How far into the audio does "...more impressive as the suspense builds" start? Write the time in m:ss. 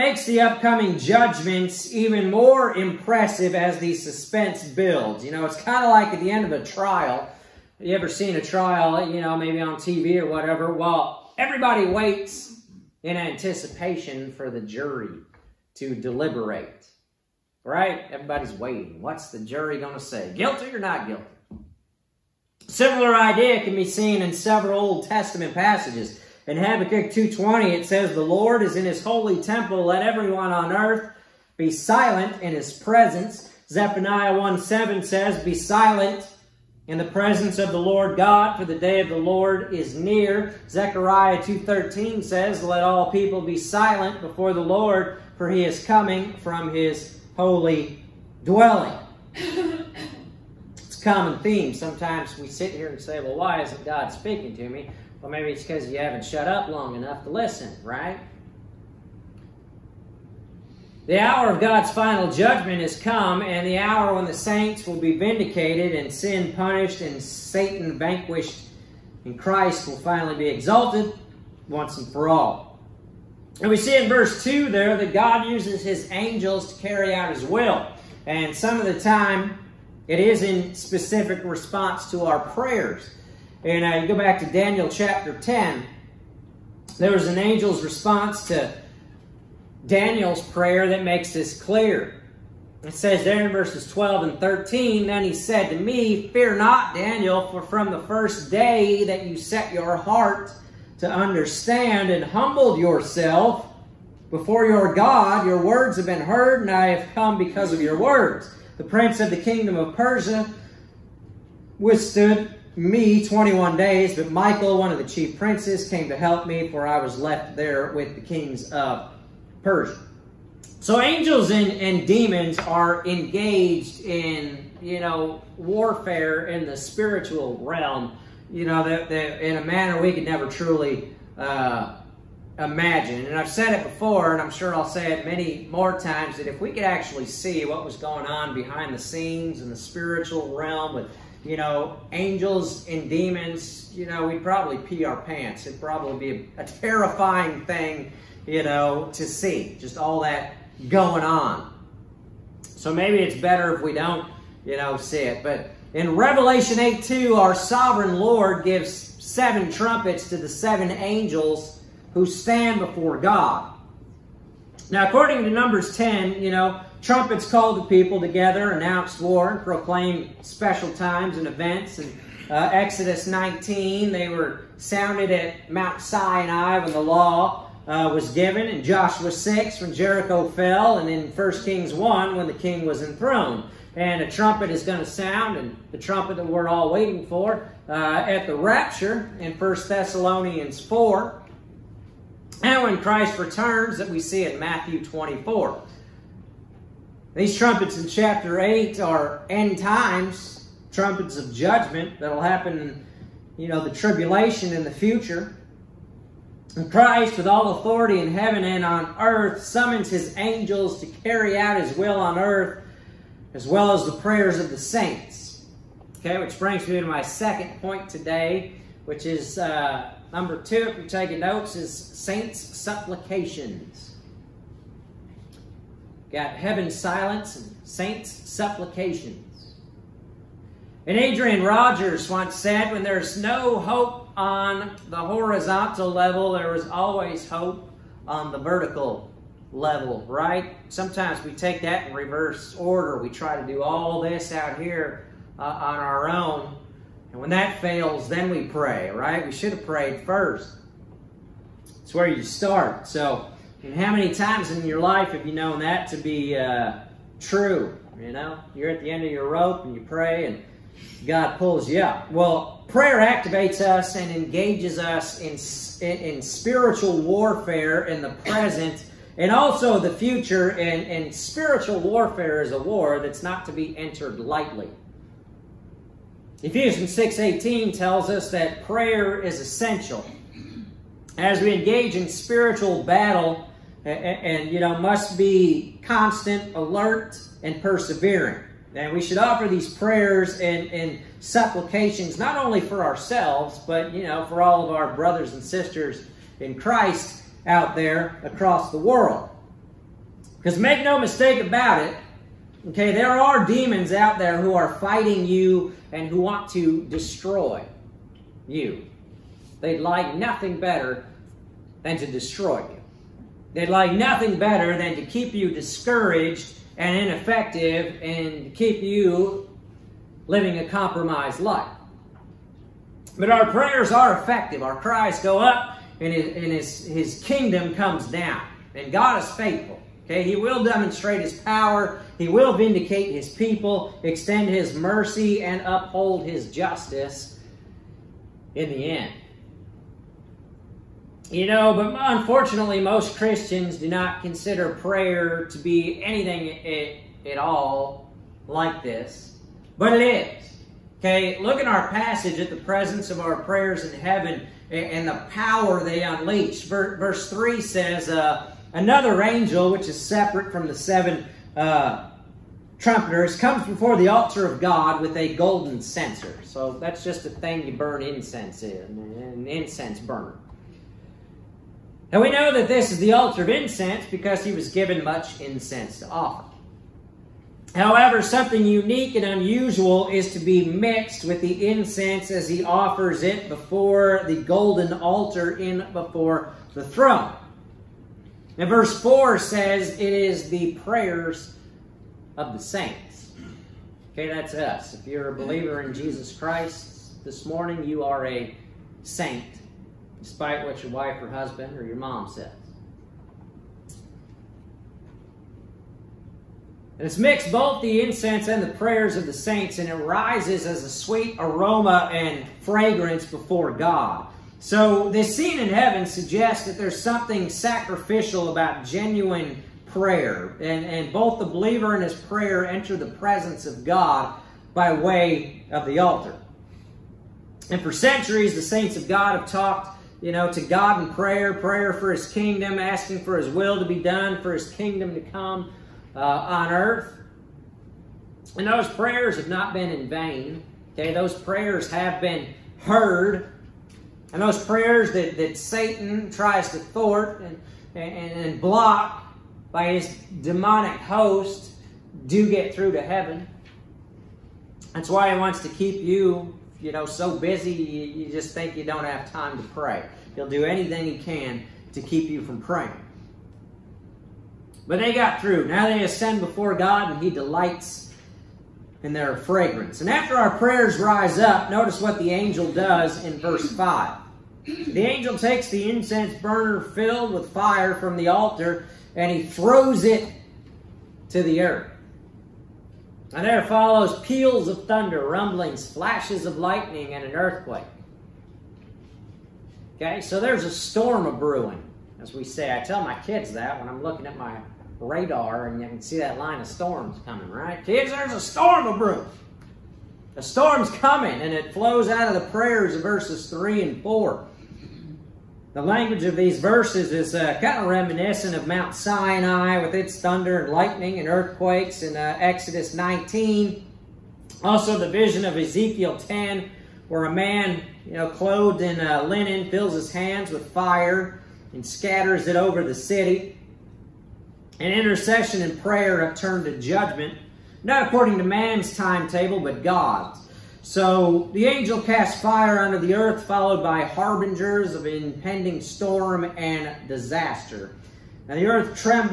0:02.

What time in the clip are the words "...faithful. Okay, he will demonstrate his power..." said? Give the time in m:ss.
5:29.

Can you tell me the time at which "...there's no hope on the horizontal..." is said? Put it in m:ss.
3:53.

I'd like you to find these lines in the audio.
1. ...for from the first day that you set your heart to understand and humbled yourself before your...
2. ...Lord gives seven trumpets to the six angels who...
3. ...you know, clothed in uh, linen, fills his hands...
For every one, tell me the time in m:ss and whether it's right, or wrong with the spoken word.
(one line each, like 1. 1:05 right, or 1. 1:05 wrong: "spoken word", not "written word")
1. 1:37 right
2. 2:38 wrong: "seven", not "six"
3. 8:38 right.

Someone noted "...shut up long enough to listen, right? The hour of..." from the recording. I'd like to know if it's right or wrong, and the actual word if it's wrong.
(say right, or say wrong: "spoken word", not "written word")
right.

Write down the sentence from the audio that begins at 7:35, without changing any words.
That's why he wants to keep you, you know, so busy you, you just think you don't have time to pray.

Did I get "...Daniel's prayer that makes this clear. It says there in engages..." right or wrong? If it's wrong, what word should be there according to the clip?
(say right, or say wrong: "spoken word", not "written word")
wrong: "verses", not "engages".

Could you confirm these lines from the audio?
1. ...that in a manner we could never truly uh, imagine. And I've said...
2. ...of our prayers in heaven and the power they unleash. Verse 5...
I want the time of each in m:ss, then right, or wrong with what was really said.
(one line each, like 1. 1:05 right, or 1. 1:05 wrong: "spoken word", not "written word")
1. 2:09 right
2. 5:53 wrong: "3", not "5".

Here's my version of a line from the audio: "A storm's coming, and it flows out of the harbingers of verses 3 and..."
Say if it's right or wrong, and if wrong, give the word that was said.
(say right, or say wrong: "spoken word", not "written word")
wrong: "prayers", not "harbingers".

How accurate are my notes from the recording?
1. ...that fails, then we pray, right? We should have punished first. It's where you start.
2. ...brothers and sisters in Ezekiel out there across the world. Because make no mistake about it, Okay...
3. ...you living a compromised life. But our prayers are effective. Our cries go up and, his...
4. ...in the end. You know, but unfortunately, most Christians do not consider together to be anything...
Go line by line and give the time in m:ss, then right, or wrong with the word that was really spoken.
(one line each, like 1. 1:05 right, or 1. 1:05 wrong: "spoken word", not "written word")
1. 4:07 wrong: "prayed", not "punished"
2. 4:55 wrong: "Christ", not "Ezekiel"
3. 5:19 right
4. 5:38 wrong: "prayer", not "together".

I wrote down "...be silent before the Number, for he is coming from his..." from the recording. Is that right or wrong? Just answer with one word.
wrong.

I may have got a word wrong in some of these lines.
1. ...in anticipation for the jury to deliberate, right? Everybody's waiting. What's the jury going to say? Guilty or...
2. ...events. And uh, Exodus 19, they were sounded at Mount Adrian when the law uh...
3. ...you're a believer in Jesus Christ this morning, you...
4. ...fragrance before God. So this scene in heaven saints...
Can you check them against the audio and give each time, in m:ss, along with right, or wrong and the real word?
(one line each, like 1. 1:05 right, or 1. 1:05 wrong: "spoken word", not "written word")
1. 0:13 right
2. 2:51 wrong: "Sinai", not "Adrian"
3. 6:35 right
4. 6:52 wrong: "suggests", not "saints".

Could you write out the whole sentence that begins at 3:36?
Okay, which brings me to my second point today, which is uh, Number two, if you're taking notes, is saints' supplications.